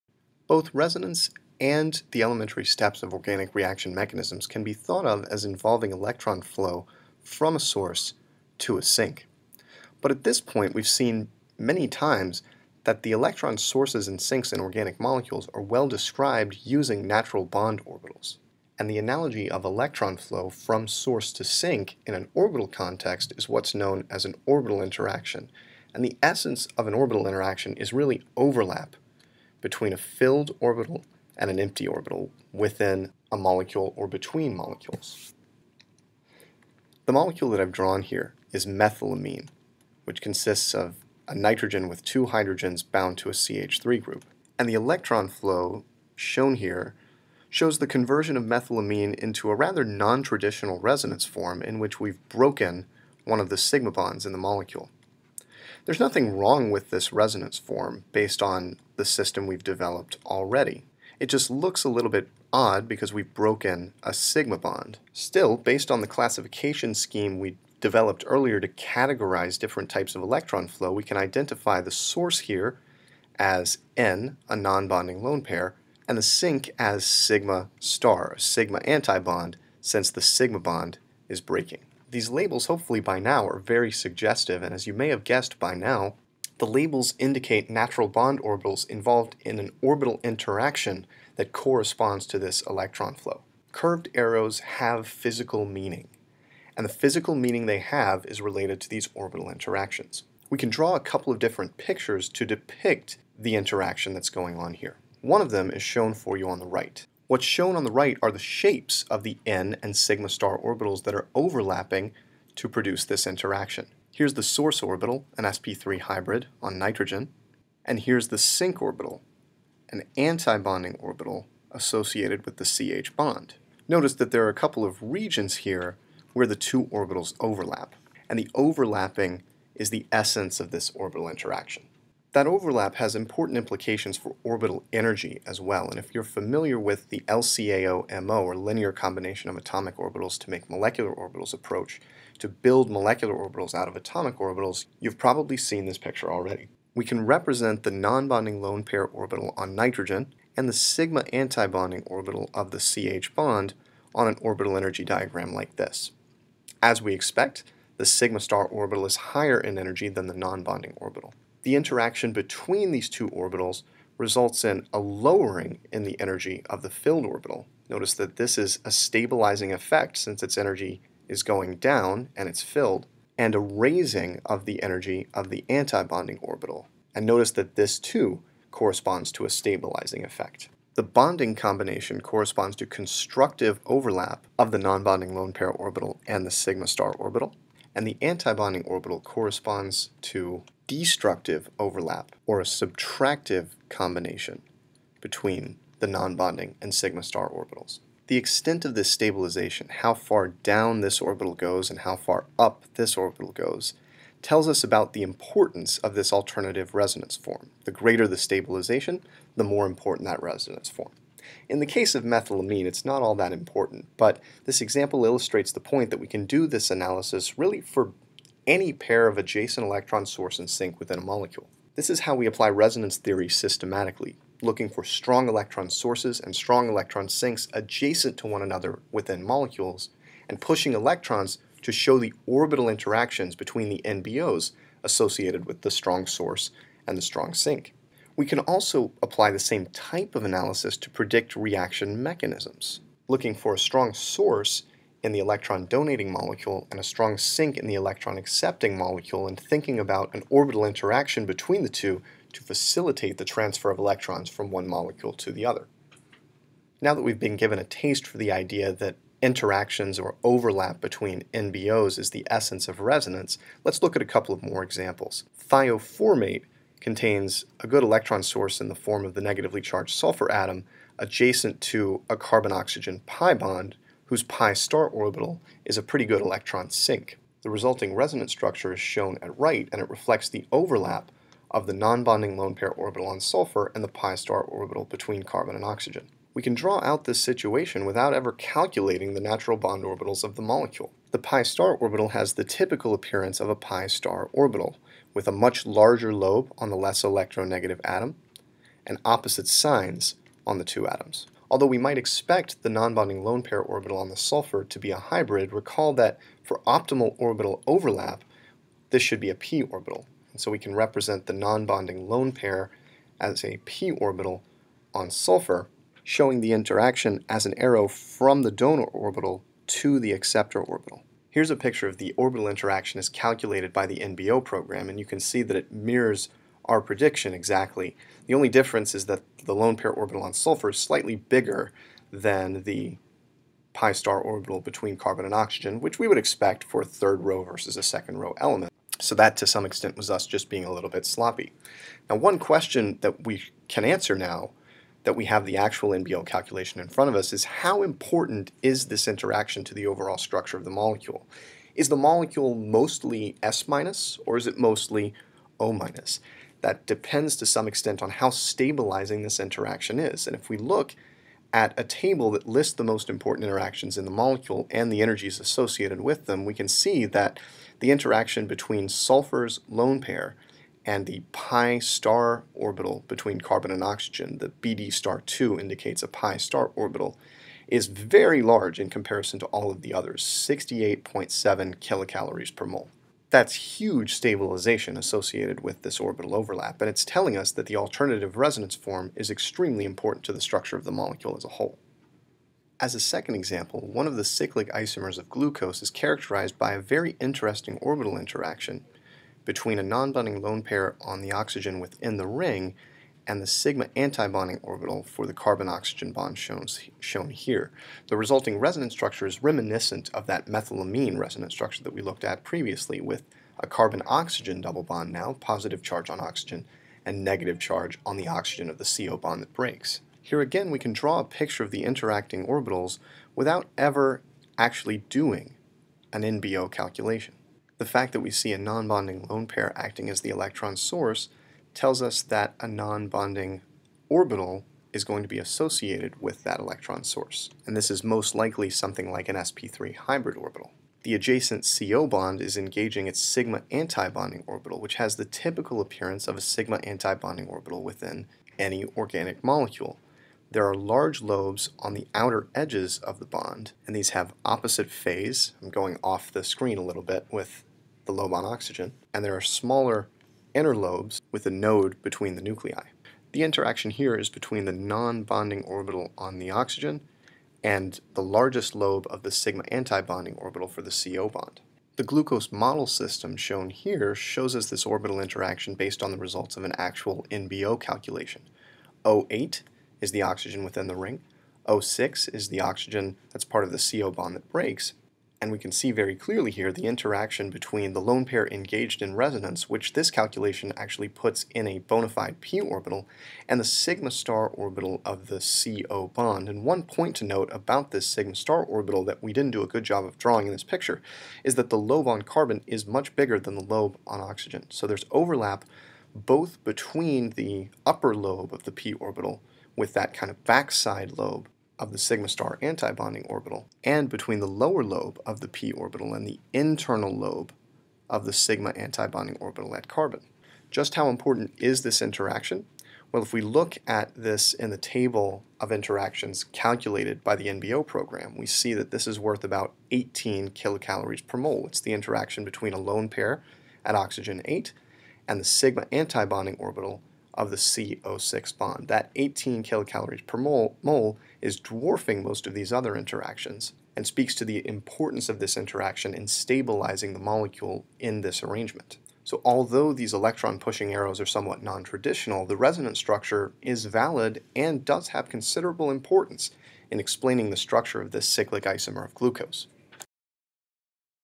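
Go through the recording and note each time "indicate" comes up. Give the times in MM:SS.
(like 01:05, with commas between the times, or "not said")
01:27, 06:15.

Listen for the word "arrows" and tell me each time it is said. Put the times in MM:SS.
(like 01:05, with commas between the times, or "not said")
01:34, 05:17, 09:11.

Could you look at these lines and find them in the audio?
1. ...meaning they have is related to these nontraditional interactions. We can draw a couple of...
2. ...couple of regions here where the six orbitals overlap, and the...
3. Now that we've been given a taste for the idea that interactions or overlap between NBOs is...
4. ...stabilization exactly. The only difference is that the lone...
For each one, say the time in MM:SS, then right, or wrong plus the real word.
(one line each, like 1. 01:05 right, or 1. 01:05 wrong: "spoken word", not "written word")
1. 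01:37 wrong: "orbital", not "nontraditional"
2. 02:04 wrong: "two", not "six"
3. 04:16 right
4. 05:27 wrong: "prediction", not "stabilization".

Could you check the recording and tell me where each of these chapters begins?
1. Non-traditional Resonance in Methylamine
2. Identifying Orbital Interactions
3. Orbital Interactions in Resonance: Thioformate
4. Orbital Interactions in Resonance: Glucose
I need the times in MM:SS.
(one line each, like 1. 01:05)
1. 00:36
2. 03:42
3. 04:17
4. 06:33.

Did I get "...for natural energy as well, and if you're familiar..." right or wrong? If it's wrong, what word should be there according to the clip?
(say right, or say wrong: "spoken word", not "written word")
wrong: "orbital", not "natural".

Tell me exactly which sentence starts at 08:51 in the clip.
It's the interaction between a lone pair at oxygen 8 and the sigma antibonding orbital of the CO6 bond.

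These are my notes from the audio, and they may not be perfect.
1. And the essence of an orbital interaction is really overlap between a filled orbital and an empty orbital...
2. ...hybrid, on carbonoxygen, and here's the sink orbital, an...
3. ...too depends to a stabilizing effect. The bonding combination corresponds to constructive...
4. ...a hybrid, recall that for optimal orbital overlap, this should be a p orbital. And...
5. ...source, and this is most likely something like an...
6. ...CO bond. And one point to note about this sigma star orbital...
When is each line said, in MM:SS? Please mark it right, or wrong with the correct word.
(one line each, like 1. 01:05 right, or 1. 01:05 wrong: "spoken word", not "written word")
1. 00:25 right
2. 01:56 wrong: "nitrogen", not "carbonoxygen"
3. 02:57 wrong: "corresponds", not "depends"
4. 05:05 right
5. 07:17 right
6. 08:15 right.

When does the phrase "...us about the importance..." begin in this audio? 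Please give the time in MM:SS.
03:24.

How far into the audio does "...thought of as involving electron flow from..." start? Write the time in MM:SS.
00:04.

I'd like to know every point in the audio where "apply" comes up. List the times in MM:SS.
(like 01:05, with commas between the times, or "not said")
03:42, 03:59.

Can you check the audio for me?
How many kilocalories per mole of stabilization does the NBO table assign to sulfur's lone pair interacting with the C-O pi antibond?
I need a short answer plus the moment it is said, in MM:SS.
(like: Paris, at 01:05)
68.7, at 06:20.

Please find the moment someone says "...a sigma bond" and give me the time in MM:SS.
01:04.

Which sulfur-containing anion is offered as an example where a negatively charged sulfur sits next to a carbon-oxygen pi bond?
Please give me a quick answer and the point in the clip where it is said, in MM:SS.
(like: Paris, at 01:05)
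Thioformate, at 04:25.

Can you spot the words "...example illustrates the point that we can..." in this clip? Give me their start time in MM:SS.
03:34.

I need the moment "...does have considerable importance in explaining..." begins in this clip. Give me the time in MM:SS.
09:15.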